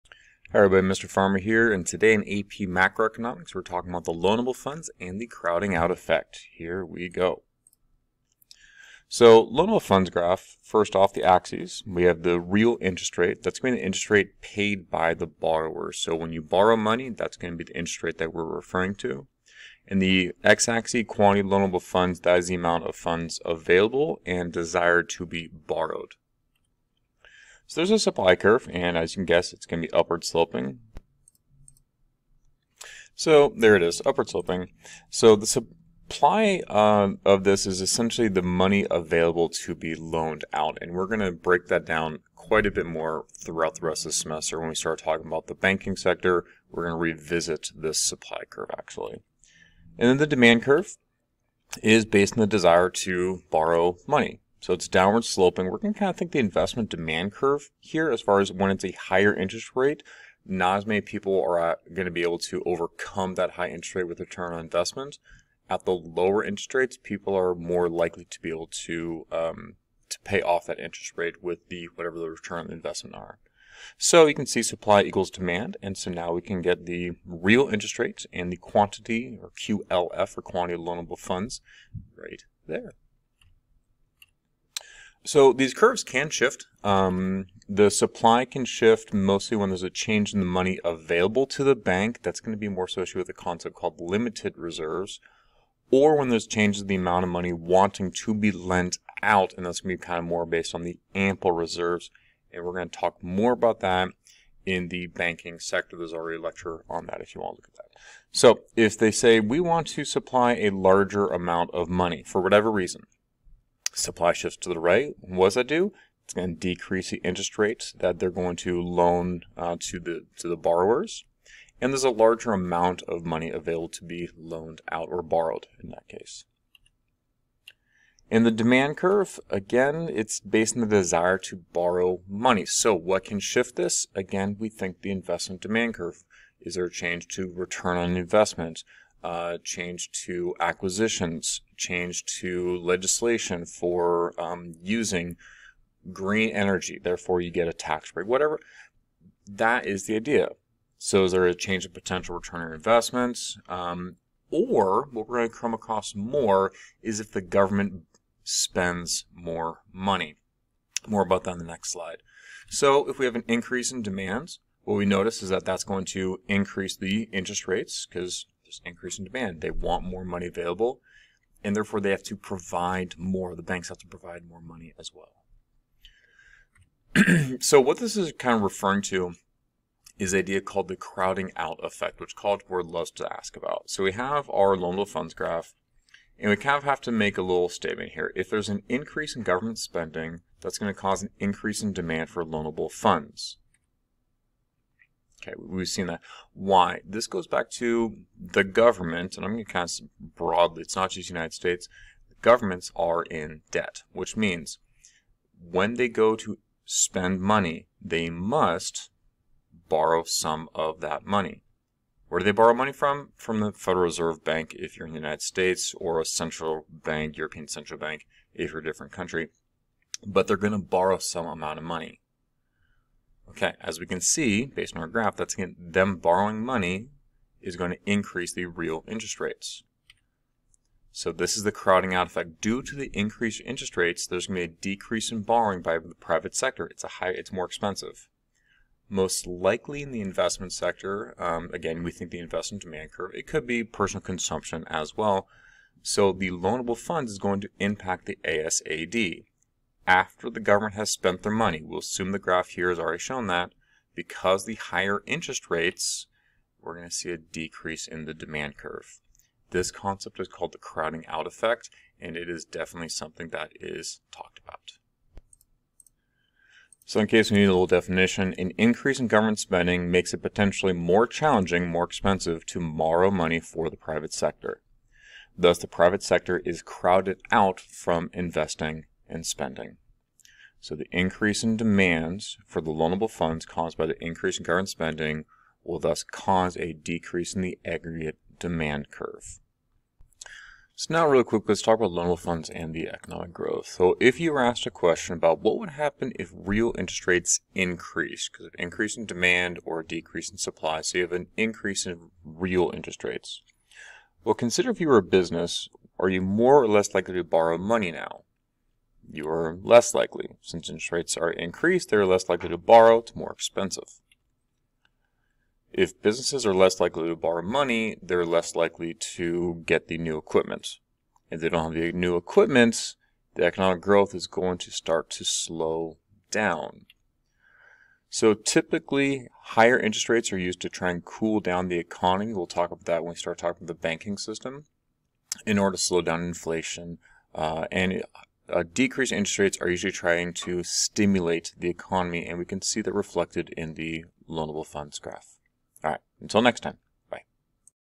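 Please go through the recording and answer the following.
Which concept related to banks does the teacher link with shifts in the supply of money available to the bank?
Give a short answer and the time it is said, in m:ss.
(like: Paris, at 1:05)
limited reserves, at 1:34.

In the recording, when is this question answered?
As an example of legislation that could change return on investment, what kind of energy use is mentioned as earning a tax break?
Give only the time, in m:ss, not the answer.
2:26.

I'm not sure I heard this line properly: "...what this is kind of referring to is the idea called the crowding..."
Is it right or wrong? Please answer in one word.
right.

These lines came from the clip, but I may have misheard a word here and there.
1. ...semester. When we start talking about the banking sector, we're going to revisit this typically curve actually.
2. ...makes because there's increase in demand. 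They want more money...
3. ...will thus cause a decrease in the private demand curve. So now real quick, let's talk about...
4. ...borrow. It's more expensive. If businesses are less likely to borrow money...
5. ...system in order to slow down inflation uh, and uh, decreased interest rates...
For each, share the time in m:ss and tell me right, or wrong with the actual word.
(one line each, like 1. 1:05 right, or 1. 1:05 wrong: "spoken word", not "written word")
1. 0:44 wrong: "supply", not "typically"
2. 2:47 wrong: "rates", not "makes"
3. 4:45 wrong: "aggregate", not "private"
4. 5:12 right
5. 5:34 right.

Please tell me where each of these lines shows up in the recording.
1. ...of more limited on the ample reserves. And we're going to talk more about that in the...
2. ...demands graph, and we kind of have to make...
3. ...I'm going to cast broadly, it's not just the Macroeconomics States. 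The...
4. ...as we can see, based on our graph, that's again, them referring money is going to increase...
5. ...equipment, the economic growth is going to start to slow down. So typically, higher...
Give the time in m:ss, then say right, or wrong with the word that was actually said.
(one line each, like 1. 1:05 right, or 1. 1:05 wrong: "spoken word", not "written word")
1. 1:40 wrong: "based", not "limited"
2. 3:05 wrong: "funds", not "demands"
3. 3:19 wrong: "United", not "Macroeconomics"
4. 3:43 wrong: "borrowing", not "referring"
5. 5:22 right.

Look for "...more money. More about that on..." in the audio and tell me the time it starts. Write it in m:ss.
2:39.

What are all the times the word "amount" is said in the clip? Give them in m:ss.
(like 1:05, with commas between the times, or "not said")
0:22, 1:36, 1:51, 2:02, 3:41.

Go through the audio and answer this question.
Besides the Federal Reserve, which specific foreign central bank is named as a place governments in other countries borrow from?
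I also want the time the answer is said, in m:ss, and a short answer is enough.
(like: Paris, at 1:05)
European Central Bank, at 3:37.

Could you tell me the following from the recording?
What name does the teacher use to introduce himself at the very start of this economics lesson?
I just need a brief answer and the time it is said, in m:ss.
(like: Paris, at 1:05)
Mr. Farmer, at 0:00.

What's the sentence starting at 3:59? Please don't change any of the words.
Most likely in the investment sector, um, again, we think the investment demand curve.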